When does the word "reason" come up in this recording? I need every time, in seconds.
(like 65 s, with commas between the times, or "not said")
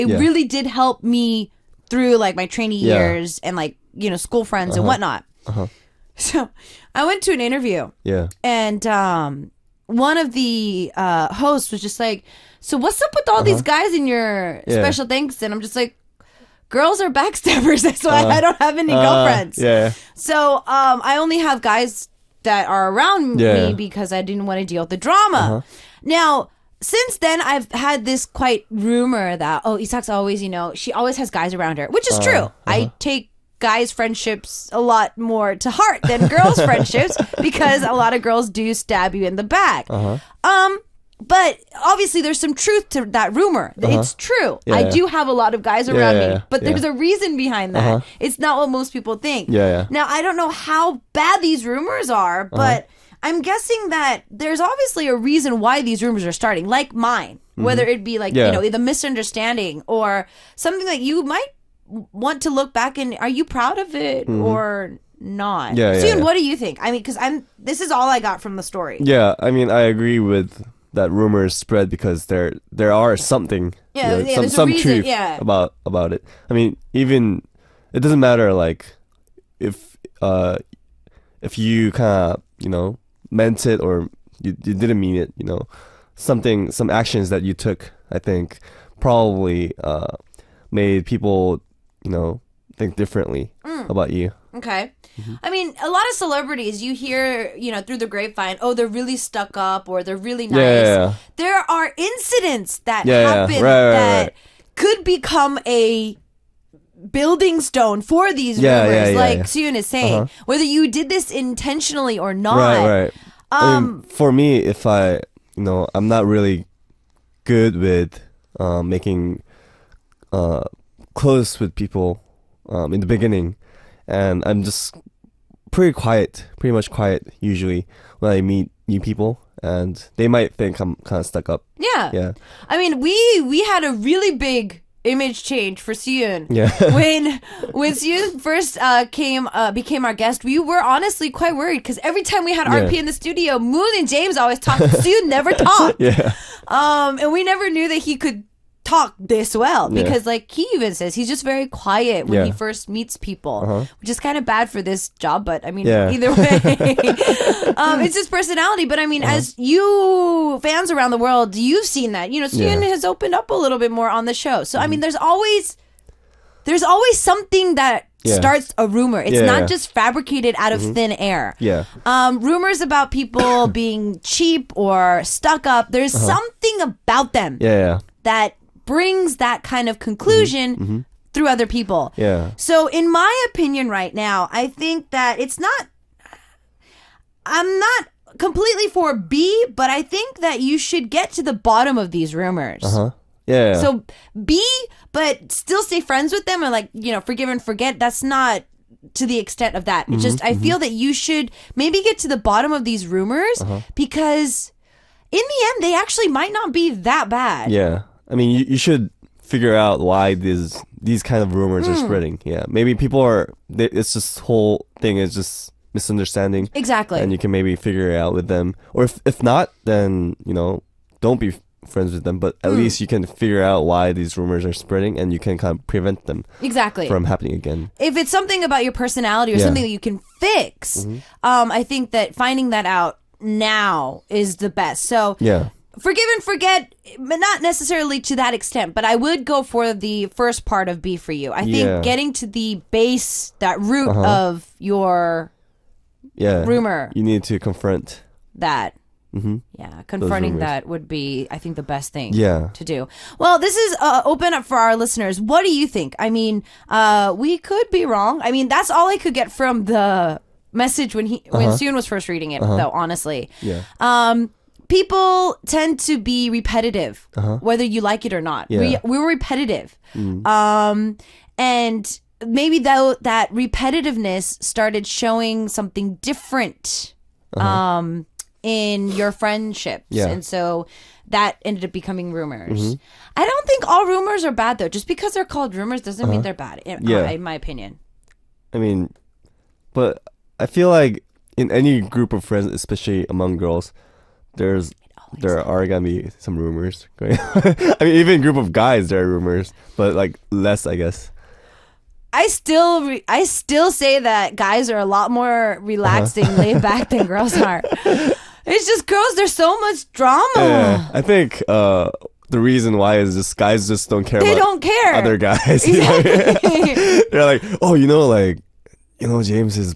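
46 s, 55 s, 74 s, 312 s.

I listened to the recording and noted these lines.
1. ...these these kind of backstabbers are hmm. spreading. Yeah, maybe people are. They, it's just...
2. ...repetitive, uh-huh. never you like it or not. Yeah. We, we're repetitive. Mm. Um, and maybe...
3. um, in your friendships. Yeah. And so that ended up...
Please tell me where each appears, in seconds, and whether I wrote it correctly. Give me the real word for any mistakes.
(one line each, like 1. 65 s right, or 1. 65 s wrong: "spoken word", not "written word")
1. 210 s wrong: "rumors", not "backstabbers"
2. 266 s wrong: "whether", not "never"
3. 277 s right.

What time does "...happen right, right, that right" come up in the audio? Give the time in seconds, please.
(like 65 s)
103 s.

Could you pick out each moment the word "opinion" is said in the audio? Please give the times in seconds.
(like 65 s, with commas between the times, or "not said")
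183 s, 287 s.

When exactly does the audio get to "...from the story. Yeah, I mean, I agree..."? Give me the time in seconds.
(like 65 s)
68 s.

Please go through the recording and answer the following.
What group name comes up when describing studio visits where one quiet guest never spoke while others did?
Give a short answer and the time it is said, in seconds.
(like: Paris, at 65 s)
RP, at 142 s.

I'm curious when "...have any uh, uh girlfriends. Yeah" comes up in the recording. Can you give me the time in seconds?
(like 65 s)
18 s.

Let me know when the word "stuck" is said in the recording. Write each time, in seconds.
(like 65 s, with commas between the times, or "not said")
99 s, 131 s, 175 s.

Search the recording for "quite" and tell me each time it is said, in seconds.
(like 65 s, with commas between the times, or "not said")
28 s, 141 s.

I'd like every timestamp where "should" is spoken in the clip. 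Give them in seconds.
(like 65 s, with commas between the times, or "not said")
190 s, 201 s, 208 s.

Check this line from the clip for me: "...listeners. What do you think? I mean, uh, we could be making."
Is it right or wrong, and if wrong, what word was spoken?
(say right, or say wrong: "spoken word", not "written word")
wrong: "wrong", not "making".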